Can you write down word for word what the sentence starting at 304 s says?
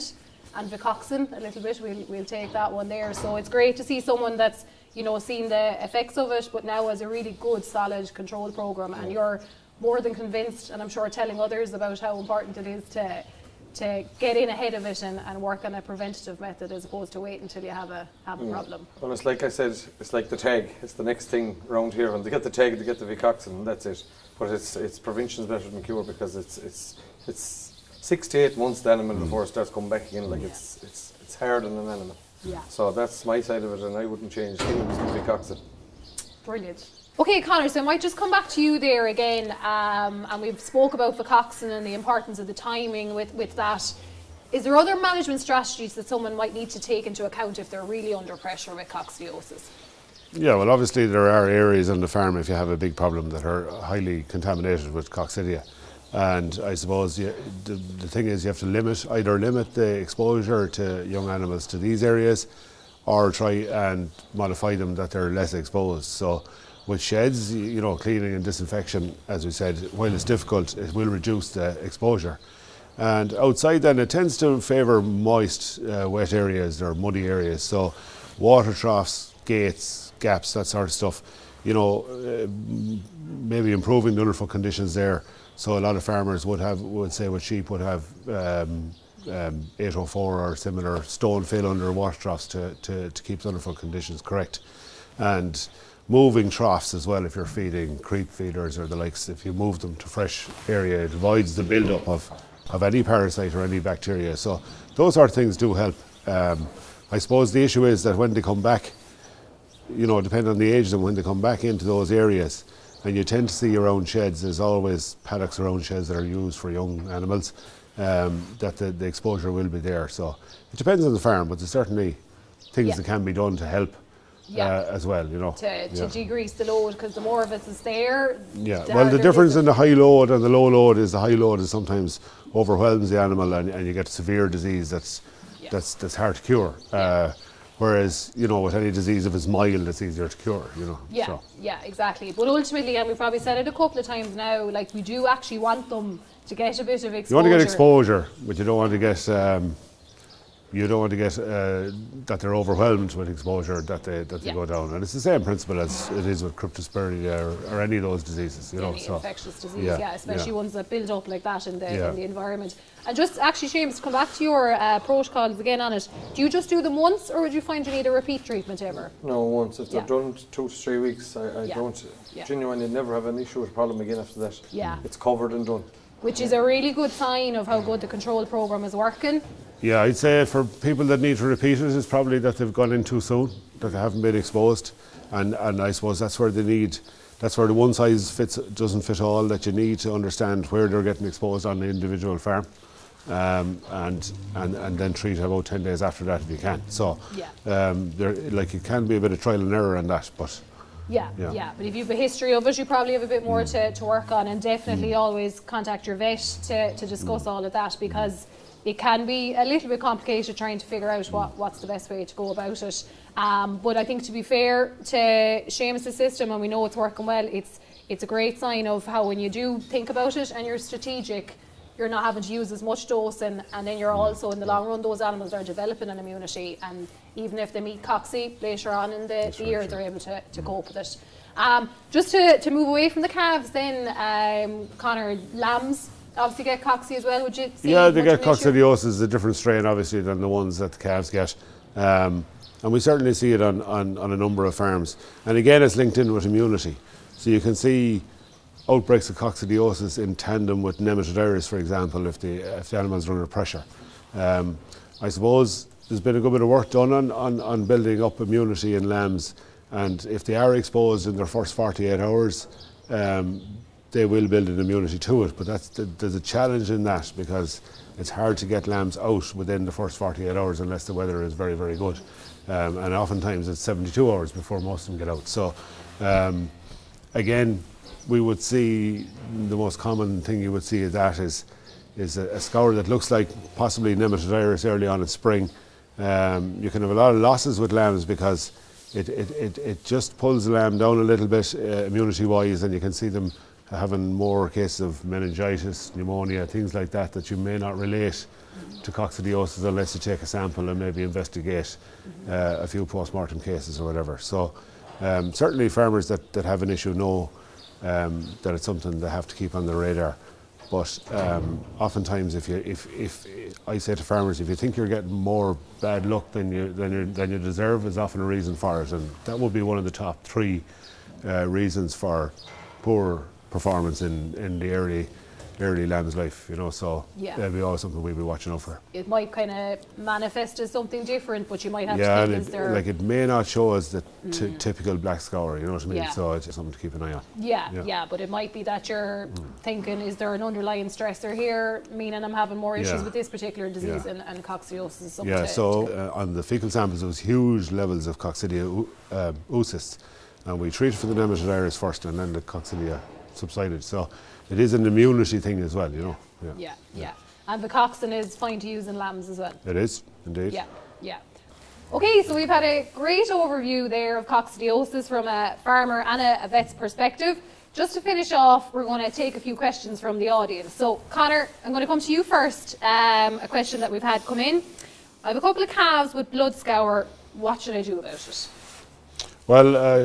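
So um, certainly farmers that, that have an issue know um, that it's something they have to keep on the radar.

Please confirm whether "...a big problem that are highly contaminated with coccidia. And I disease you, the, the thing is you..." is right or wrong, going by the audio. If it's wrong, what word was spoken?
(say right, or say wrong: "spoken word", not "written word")
wrong: "suppose", not "disease".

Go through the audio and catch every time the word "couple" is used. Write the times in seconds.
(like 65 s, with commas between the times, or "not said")
143 s, 375 s.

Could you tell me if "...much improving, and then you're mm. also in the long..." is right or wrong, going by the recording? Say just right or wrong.
wrong.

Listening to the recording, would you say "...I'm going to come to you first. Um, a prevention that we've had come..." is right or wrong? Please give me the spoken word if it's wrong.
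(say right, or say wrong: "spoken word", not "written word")
wrong: "question", not "prevention".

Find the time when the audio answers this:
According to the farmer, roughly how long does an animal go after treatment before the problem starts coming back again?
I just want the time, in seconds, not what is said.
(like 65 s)
27 s.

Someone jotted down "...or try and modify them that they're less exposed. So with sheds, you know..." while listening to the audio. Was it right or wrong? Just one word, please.
right.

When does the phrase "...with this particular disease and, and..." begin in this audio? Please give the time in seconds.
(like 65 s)
343 s.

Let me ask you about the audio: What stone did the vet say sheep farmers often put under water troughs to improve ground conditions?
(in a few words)
804.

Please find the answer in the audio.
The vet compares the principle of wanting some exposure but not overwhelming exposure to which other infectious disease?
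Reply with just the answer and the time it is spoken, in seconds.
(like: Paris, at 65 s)
cryptosporidia, at 156 s.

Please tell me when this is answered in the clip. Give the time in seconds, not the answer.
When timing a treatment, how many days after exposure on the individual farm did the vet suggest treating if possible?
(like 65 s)
195 s.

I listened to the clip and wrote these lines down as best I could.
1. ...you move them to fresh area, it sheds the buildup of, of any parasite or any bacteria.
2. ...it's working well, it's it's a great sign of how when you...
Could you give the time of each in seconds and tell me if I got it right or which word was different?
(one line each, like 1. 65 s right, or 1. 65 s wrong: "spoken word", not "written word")
1. 99 s wrong: "avoids", not "sheds"
2. 216 s right.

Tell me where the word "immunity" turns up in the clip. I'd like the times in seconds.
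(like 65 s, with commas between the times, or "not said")
226 s, 246 s, 258 s, 264 s, 292 s, 355 s.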